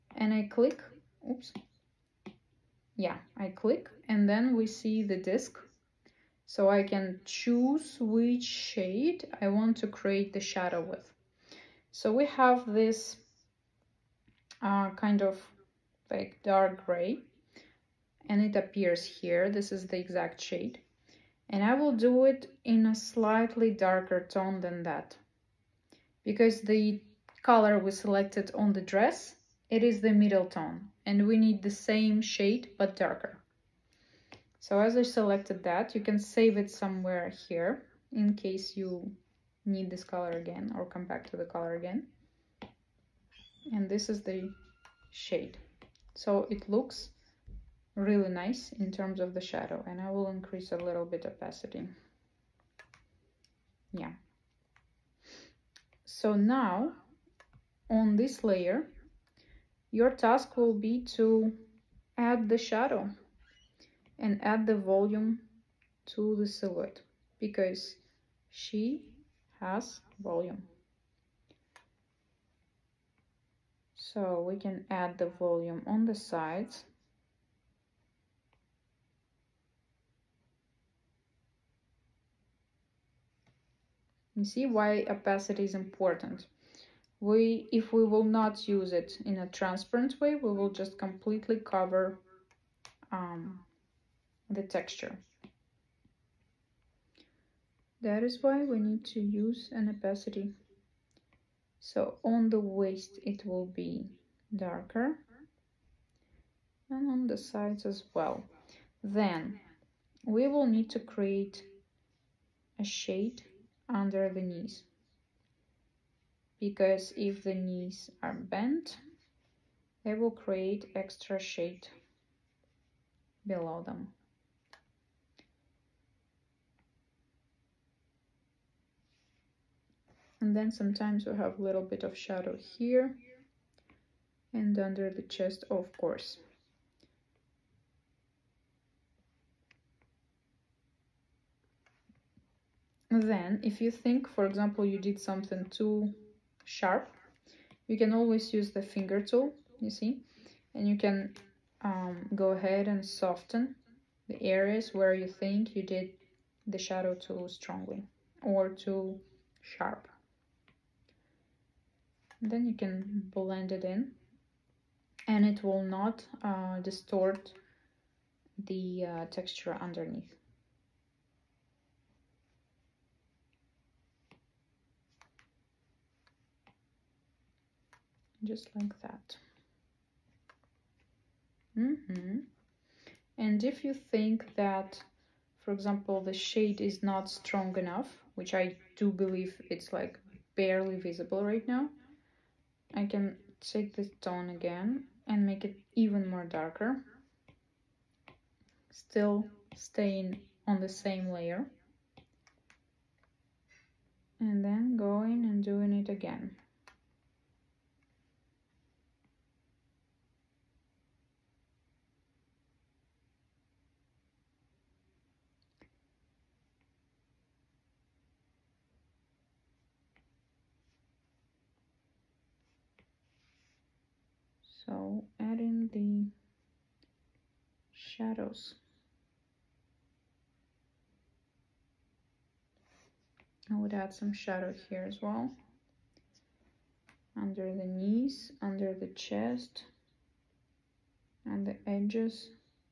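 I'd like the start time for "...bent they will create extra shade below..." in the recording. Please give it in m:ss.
1:58.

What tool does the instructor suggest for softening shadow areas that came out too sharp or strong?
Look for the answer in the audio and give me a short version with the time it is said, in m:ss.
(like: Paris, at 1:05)
finger tool, at 2:28.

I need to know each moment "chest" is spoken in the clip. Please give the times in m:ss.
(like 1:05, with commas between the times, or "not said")
2:15, 3:59.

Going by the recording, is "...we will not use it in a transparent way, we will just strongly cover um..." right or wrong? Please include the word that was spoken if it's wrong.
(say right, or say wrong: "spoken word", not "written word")
wrong: "completely", not "strongly".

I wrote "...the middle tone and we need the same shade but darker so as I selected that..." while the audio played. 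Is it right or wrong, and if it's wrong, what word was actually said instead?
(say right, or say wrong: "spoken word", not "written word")
right.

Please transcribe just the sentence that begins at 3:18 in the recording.
Still staying on the same layer.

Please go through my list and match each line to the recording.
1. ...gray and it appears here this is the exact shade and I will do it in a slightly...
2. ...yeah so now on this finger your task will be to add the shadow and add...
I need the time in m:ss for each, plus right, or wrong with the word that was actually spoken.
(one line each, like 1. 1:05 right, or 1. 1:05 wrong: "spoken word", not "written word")
1. 0:16 right
2. 0:53 wrong: "layer", not "finger".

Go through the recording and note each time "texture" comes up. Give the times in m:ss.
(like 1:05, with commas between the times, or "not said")
1:34, 2:49.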